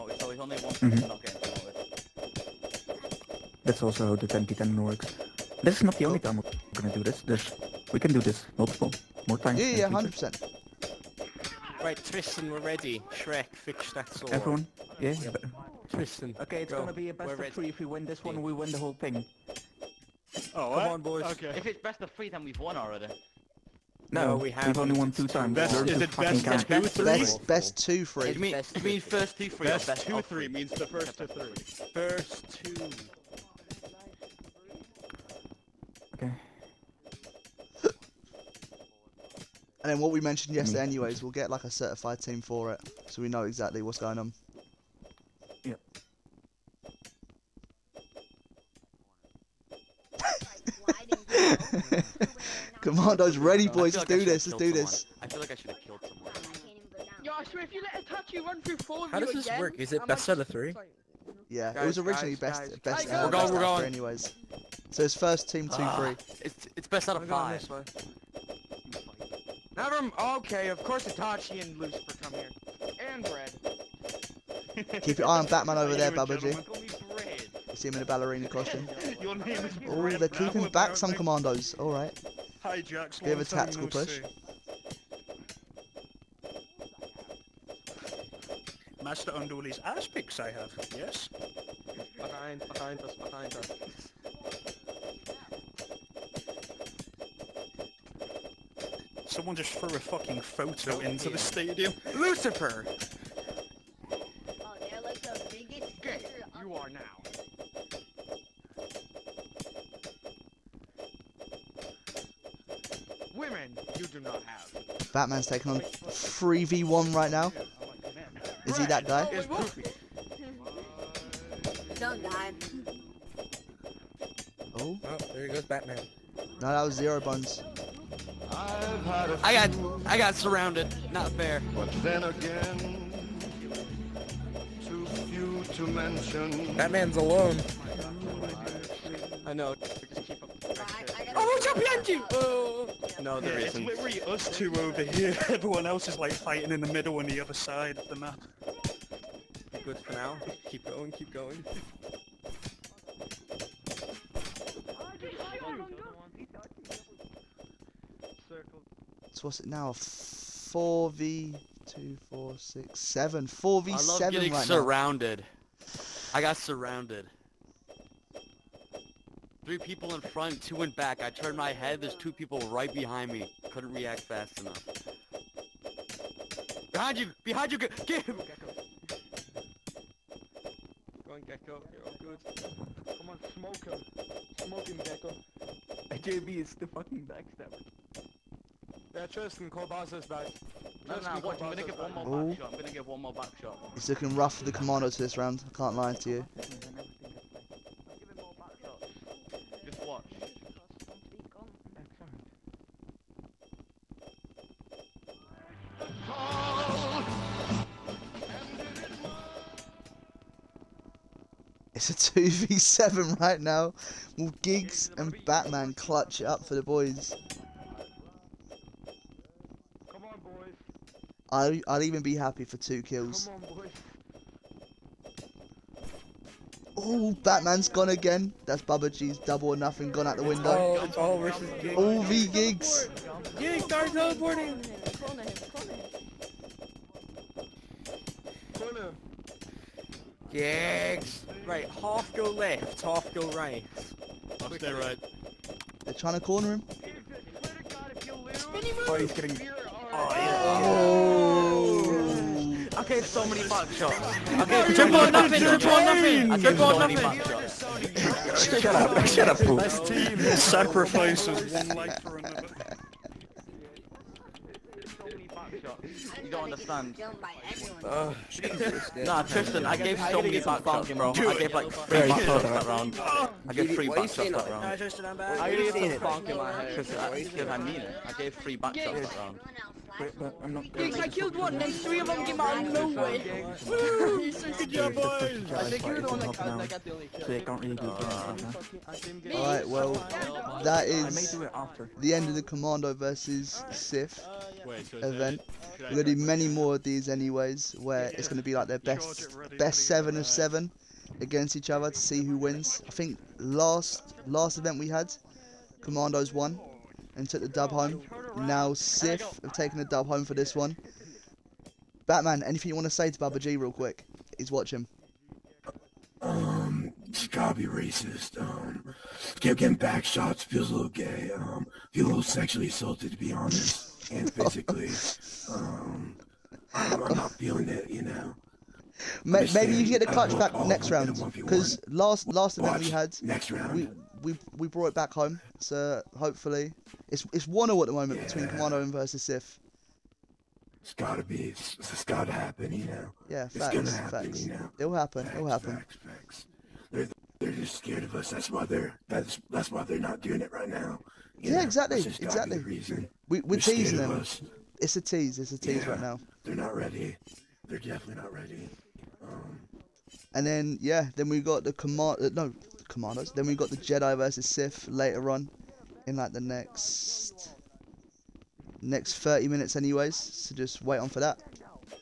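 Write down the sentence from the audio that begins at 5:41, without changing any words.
It's, it's gotta happen, you know.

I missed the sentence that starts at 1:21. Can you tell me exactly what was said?
All right you have a tactical push.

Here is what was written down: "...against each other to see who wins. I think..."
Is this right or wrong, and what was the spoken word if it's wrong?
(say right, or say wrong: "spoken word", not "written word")
right.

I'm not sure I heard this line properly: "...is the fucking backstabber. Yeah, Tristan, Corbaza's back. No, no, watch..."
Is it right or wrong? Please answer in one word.
right.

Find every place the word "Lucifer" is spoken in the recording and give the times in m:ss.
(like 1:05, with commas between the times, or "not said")
1:11, 1:42.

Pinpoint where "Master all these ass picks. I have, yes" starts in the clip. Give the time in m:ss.
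1:29.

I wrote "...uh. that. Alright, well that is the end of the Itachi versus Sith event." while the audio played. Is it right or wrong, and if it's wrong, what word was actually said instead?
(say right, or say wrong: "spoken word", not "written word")
wrong: "Commando", not "Itachi".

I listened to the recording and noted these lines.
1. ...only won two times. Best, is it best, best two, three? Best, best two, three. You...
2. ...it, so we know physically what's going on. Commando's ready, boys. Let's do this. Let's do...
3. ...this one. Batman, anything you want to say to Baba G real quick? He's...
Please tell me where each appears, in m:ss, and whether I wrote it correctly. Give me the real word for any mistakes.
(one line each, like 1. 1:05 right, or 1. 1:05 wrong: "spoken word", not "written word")
1. 0:24 right
2. 0:42 wrong: "exactly", not "physically"
3. 5:10 right.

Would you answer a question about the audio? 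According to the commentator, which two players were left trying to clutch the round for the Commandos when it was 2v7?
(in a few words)
Giggs and Batman.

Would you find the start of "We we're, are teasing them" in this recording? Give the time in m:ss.
5:53.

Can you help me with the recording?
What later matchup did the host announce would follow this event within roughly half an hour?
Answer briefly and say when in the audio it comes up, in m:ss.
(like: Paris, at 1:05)
Jedi versus Sith, at 6:03.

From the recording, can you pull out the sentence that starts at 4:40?
Wait, i killed one, then three of them came out of nowhere.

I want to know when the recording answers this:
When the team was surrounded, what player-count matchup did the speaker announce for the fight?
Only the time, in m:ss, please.
2:43.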